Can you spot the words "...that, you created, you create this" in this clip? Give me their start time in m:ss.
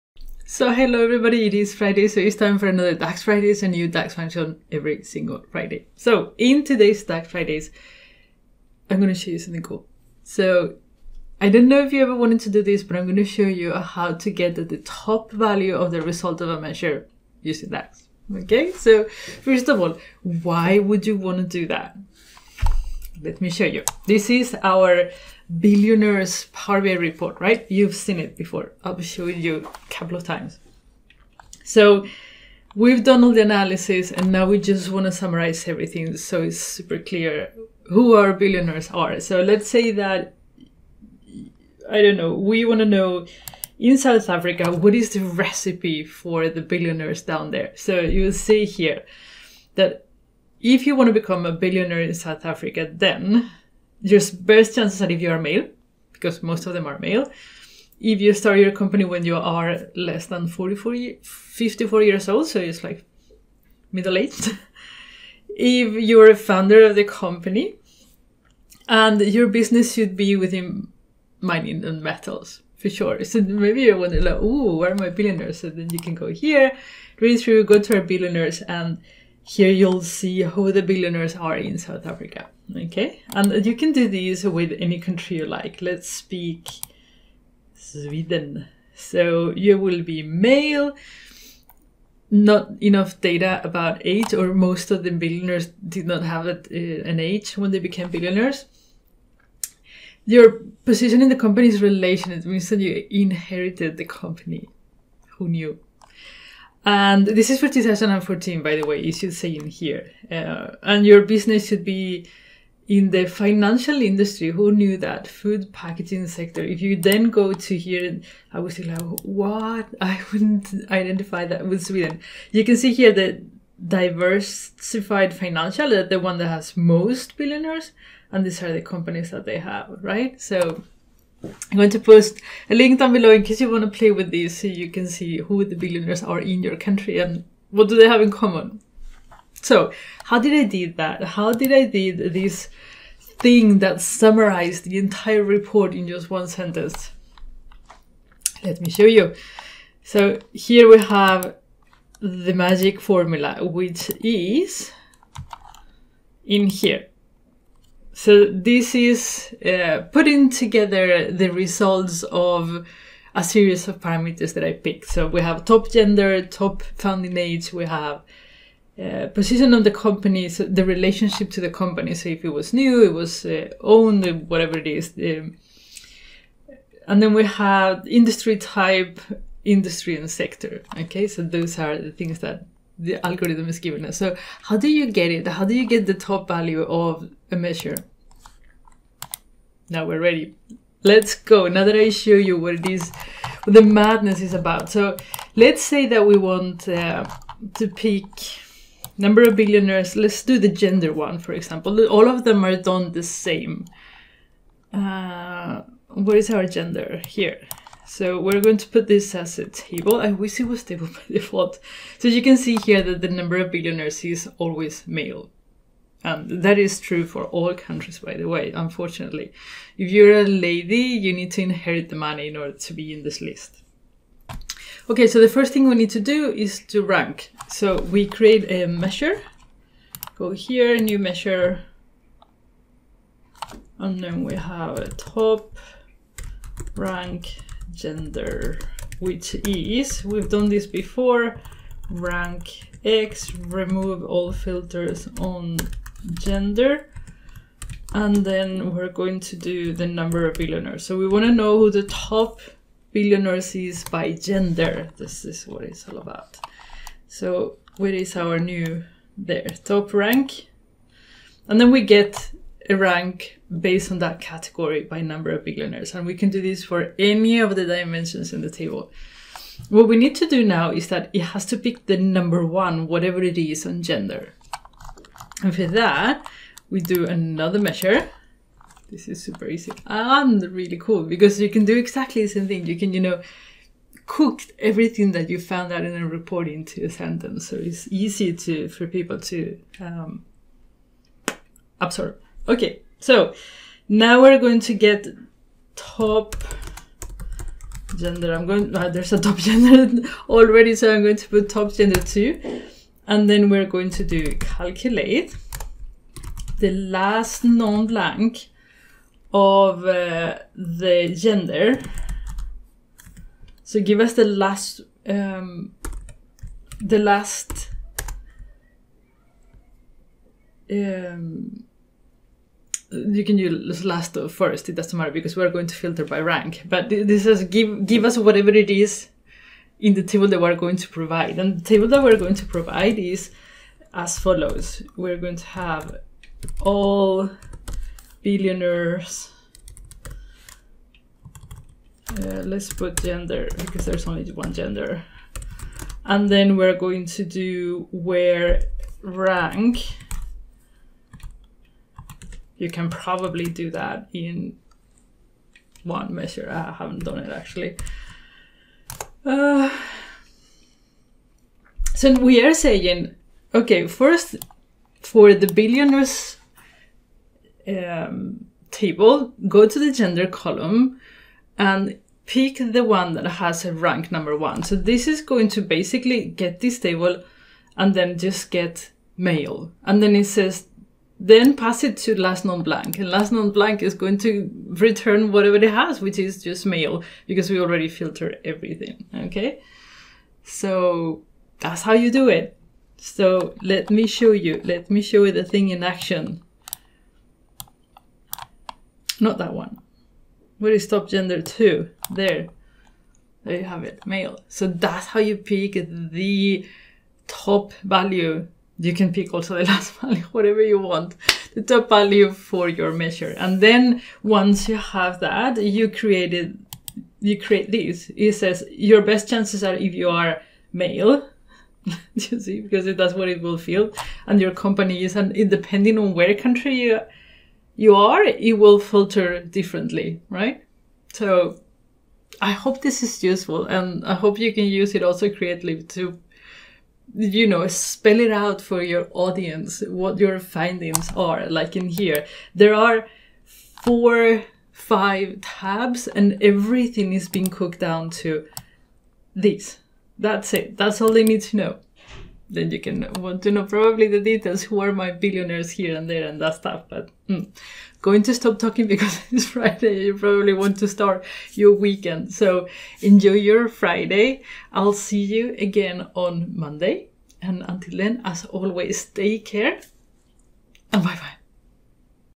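6:55.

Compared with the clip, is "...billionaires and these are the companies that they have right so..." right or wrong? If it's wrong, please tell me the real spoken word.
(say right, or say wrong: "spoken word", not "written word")
right.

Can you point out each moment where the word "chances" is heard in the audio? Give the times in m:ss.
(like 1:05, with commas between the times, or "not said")
0:54, 6:59.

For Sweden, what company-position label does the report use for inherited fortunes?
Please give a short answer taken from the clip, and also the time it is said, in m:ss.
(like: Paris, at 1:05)
Relation, at 1:41.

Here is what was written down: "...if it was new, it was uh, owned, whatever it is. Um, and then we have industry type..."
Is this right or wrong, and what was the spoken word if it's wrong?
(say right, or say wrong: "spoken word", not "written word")
right.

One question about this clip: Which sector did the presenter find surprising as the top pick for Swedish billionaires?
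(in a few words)
Food packaging.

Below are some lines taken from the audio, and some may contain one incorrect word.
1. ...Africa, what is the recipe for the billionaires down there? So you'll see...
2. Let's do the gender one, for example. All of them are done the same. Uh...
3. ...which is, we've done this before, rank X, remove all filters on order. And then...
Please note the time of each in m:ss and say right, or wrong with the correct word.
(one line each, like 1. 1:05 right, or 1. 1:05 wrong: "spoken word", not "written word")
1. 0:44 right
2. 3:20 right
3. 3:59 wrong: "gender", not "order".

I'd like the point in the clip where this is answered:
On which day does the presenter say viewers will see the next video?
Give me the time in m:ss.
7:46.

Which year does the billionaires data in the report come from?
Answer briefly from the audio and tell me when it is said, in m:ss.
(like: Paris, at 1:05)
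2014, at 1:47.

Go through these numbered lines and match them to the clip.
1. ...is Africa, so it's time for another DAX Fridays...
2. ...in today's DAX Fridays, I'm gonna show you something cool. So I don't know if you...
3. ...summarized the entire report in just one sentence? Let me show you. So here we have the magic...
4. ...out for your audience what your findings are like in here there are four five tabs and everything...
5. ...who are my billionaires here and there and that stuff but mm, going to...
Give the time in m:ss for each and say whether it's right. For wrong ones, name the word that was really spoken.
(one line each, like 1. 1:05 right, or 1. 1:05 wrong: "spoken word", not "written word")
1. 0:01 wrong: "Friday", not "Africa"
2. 0:06 right
3. 2:24 right
4. 7:18 right
5. 7:34 right.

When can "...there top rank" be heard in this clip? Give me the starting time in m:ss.
4:19.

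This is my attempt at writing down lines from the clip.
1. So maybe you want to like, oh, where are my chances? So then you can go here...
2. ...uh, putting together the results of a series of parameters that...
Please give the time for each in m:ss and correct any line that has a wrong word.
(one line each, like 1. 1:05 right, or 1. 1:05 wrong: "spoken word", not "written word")
1. 1:13 wrong: "billionaires", not "chances"
2. 2:39 right.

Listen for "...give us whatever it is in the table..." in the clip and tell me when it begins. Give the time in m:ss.
5:28.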